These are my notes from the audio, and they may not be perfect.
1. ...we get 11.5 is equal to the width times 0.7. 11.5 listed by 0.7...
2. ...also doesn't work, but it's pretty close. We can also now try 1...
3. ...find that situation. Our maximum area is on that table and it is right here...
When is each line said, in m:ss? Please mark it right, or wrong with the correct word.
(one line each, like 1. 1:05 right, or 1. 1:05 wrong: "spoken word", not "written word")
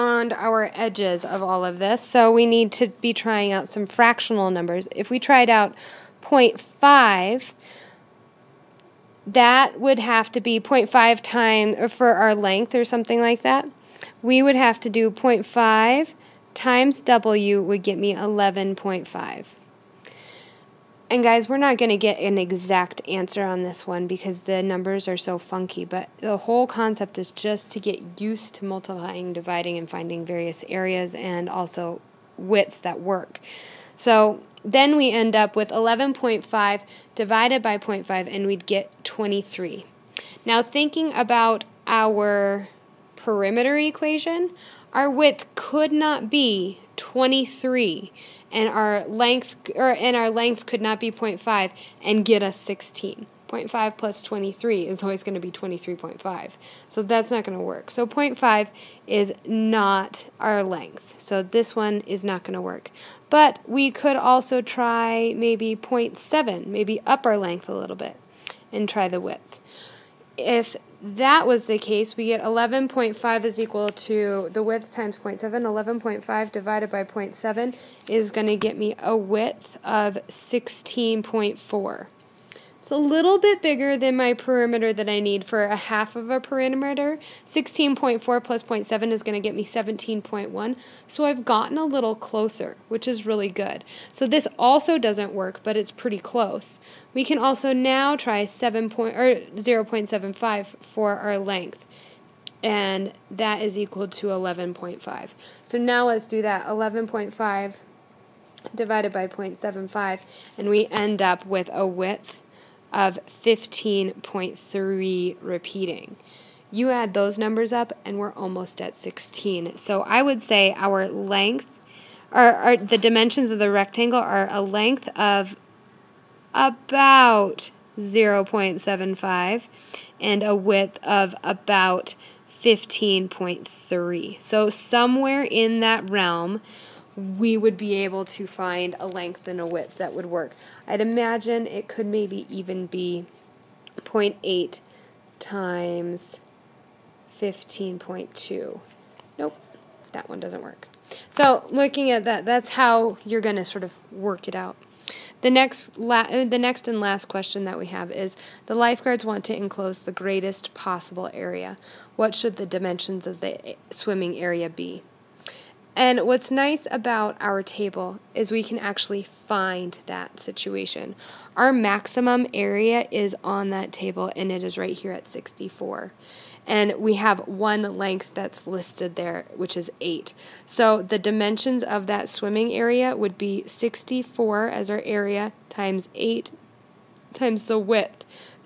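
1. 1:12 wrong: "divided", not "listed"
2. 1:34 wrong: "7", not "1"
3. 2:49 right.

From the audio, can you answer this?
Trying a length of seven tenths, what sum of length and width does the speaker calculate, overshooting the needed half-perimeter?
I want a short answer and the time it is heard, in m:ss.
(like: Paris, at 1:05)
17.1, at 1:29.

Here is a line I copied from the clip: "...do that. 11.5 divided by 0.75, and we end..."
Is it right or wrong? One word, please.
right.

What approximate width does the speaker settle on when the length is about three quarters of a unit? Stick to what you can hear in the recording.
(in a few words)
15.3.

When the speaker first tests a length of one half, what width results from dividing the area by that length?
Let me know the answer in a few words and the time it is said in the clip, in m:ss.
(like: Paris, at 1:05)
23, at 0:38.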